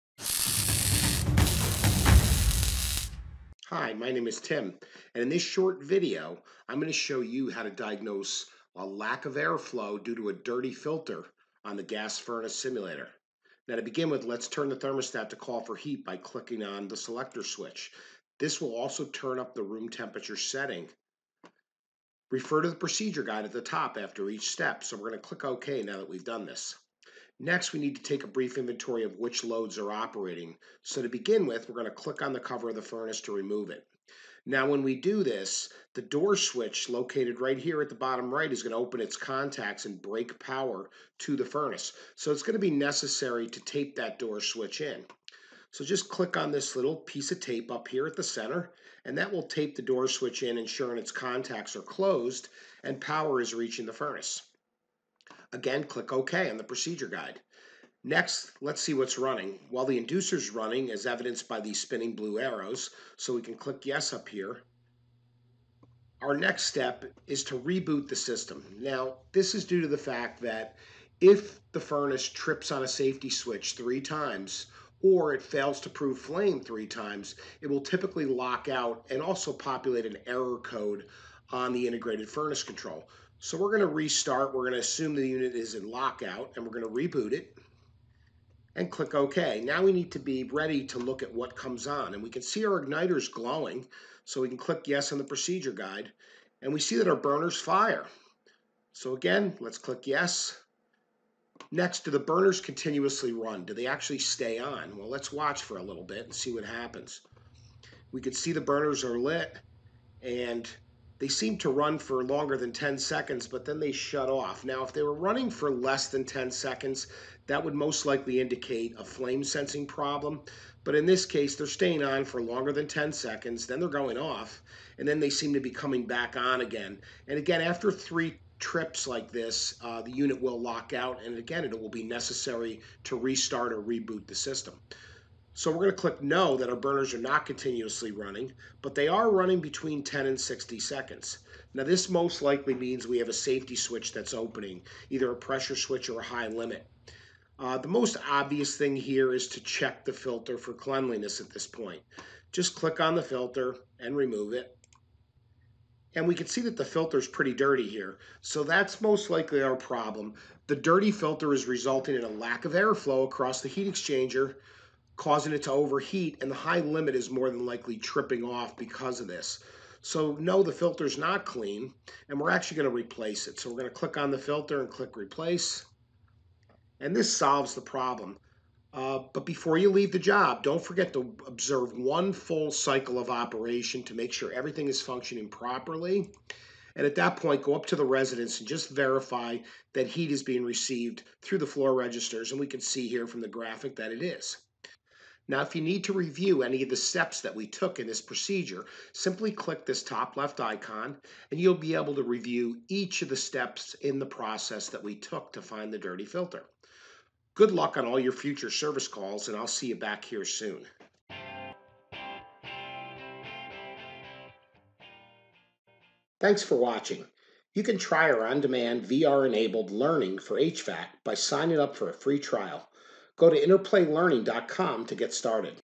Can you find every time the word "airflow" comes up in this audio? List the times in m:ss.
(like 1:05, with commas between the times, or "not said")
0:09, 2:42.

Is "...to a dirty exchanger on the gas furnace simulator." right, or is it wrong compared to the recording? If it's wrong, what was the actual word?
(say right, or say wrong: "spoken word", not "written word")
wrong: "filter", not "exchanger".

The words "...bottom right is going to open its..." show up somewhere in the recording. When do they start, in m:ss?
0:37.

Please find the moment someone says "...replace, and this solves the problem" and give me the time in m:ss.
2:55.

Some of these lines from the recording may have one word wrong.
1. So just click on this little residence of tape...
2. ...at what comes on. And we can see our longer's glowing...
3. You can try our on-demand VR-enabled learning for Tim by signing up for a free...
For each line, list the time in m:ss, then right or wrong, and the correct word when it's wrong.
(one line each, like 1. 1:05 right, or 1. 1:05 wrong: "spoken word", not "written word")
1. 0:45 wrong: "piece", not "residence"
2. 1:31 wrong: "igniter", not "longer"
3. 3:37 wrong: "HVAC", not "Tim".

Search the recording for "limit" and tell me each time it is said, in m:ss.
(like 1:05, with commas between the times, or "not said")
2:26, 2:46.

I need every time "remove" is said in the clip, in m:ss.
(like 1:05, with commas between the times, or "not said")
0:33, 2:34.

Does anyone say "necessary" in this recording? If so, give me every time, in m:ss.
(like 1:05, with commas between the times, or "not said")
0:42, 2:12.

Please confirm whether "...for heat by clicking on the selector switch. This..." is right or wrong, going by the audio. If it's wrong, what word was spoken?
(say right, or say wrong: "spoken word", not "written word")
right.